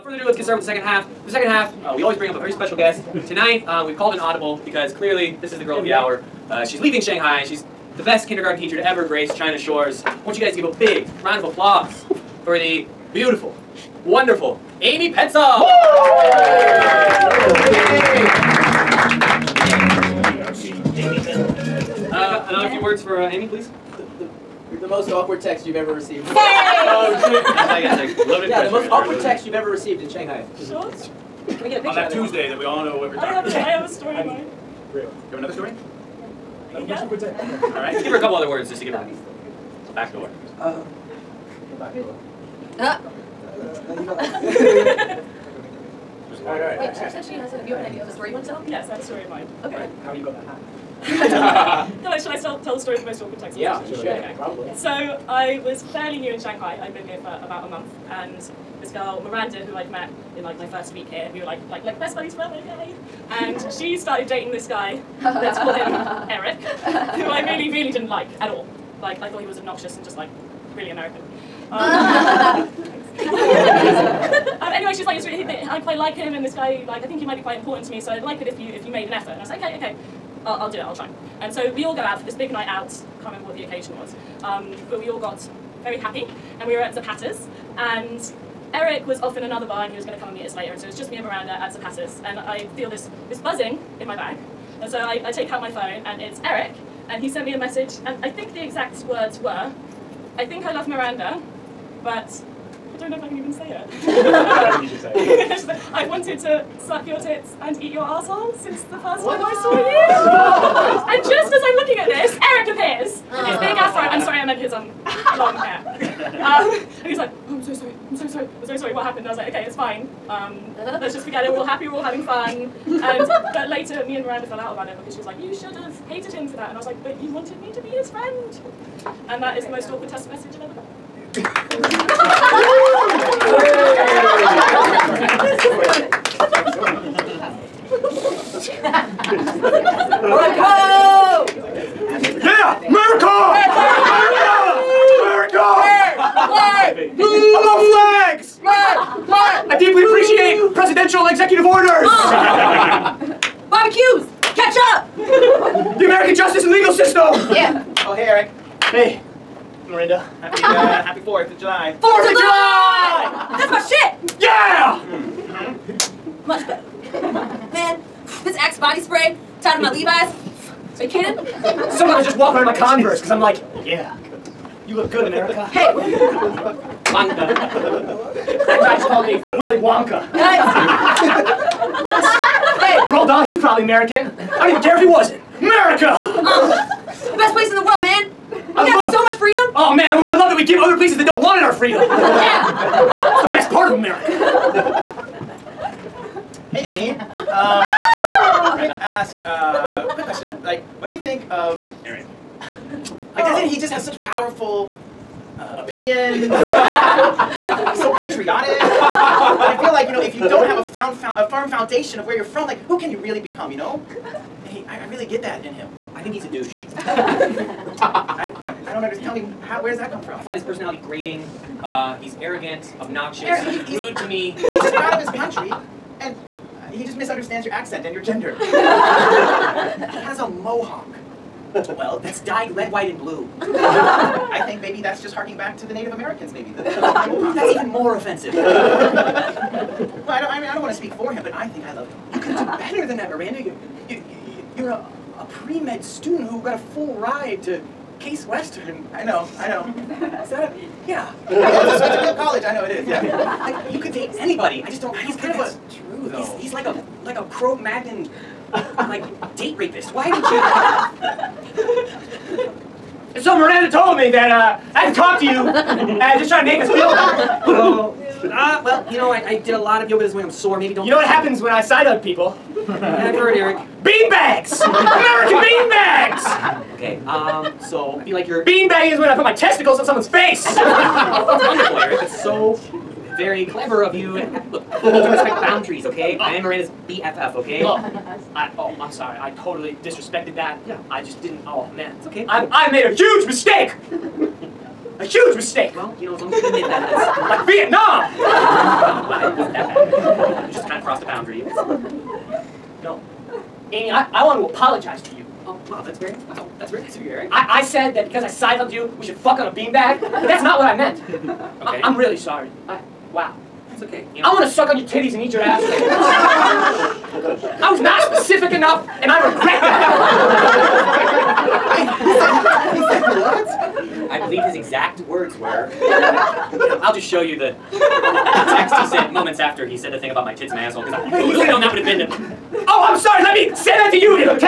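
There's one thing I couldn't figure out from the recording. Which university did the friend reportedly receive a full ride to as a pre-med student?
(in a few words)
Case Western.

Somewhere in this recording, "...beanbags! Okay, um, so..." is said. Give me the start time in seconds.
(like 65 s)
275 s.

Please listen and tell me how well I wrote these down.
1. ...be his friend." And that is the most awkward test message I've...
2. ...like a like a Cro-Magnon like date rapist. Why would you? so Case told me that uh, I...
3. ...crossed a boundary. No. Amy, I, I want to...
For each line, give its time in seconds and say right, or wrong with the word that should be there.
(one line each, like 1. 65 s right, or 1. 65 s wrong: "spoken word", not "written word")
1. 127 s right
2. 256 s wrong: "Miranda", not "Case"
3. 301 s right.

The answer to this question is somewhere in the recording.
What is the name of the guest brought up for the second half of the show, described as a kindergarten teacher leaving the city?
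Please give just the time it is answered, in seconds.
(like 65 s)
14 s.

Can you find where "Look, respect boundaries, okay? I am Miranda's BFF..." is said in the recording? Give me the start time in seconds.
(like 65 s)
284 s.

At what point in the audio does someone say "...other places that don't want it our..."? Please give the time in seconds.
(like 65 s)
190 s.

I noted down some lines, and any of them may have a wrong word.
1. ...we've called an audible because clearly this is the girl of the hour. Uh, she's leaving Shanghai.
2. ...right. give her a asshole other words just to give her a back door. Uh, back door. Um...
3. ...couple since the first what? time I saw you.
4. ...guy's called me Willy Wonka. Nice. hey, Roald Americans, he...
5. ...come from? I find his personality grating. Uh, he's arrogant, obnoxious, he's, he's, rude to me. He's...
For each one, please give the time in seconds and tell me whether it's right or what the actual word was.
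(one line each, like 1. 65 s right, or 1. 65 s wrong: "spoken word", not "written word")
1. 3 s right
2. 37 s wrong: "couple", not "asshole"
3. 108 s wrong: "asshole", not "couple"
4. 178 s wrong: "Dahl", not "Americans"
5. 220 s right.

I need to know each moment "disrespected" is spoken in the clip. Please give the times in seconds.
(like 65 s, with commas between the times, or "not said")
290 s.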